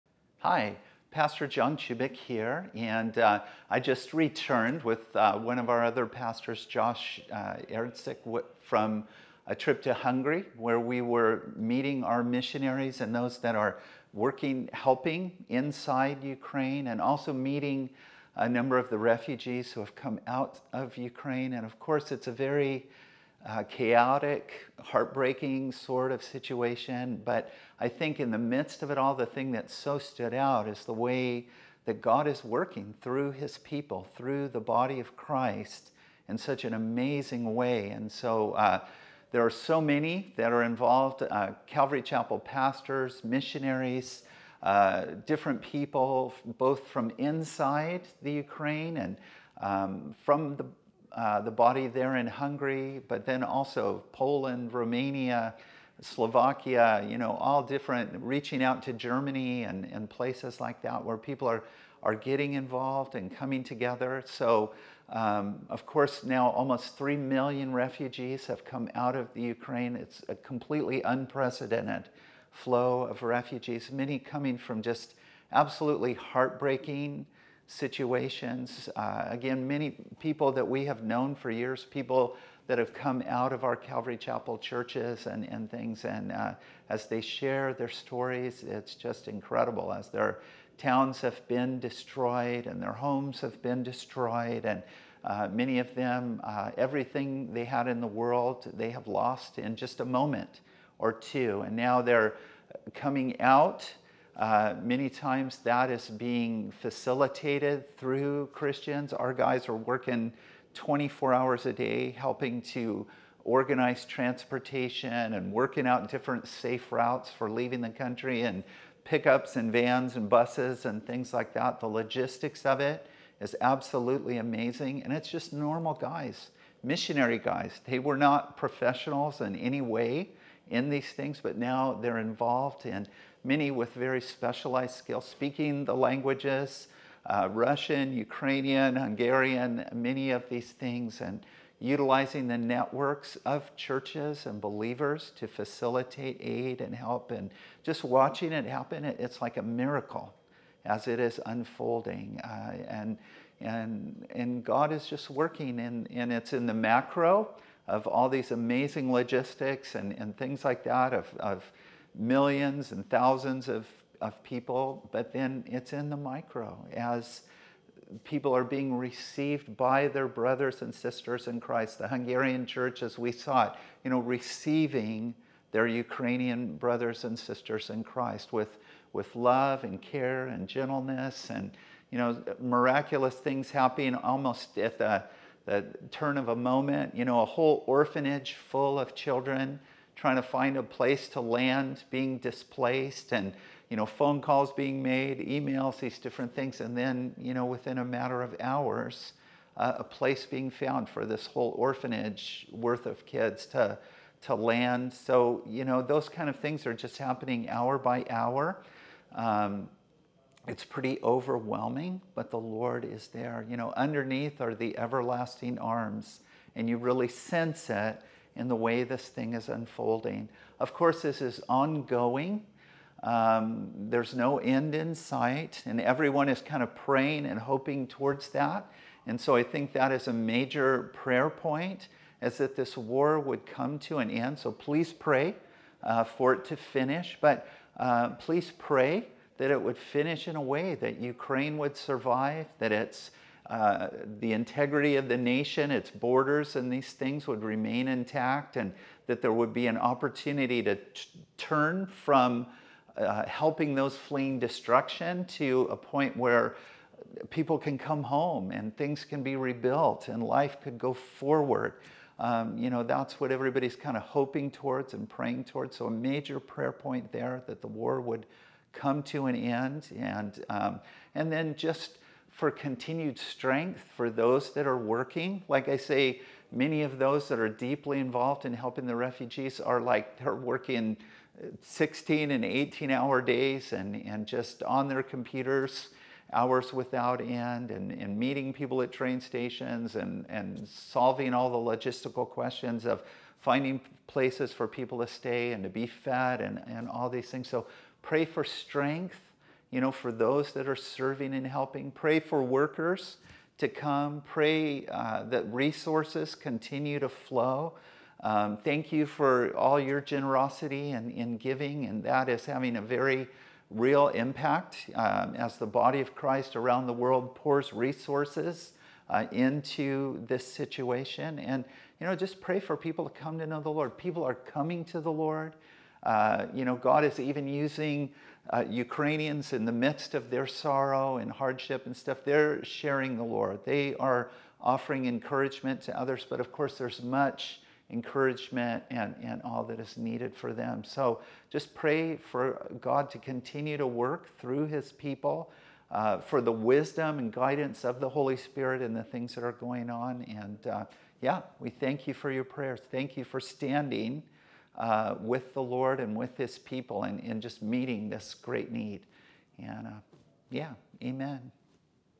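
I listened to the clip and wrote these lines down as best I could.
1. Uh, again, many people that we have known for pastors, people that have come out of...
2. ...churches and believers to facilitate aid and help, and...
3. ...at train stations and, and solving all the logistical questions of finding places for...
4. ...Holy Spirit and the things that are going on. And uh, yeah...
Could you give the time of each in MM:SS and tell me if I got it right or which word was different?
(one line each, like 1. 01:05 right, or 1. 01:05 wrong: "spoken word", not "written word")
1. 01:18 wrong: "years", not "pastors"
2. 02:23 right
3. 04:49 right
4. 05:48 right.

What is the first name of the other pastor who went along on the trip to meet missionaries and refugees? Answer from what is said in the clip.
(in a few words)
Josh.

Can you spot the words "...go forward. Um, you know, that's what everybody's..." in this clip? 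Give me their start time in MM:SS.
04:20.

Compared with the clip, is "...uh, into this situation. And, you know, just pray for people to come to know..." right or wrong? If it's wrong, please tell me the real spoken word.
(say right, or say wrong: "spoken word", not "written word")
right.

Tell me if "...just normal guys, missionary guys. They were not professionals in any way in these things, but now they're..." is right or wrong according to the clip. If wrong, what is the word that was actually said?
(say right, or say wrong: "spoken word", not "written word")
right.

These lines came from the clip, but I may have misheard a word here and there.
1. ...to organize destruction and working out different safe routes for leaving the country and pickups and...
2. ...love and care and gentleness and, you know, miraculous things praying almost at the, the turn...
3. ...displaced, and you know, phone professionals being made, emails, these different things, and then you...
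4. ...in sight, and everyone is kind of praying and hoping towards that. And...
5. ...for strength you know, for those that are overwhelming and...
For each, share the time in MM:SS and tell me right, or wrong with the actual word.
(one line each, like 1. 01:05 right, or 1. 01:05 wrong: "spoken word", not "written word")
1. 01:52 wrong: "transportation", not "destruction"
2. 02:59 wrong: "happening", not "praying"
3. 03:12 wrong: "calls", not "professionals"
4. 03:44 right
5. 04:58 wrong: "serving", not "overwhelming".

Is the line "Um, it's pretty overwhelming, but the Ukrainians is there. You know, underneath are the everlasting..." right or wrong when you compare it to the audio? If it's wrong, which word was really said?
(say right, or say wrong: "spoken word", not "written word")
wrong: "Lord", not "Ukrainians".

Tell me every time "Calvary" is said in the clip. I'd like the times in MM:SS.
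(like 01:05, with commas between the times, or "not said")
00:41, 01:23.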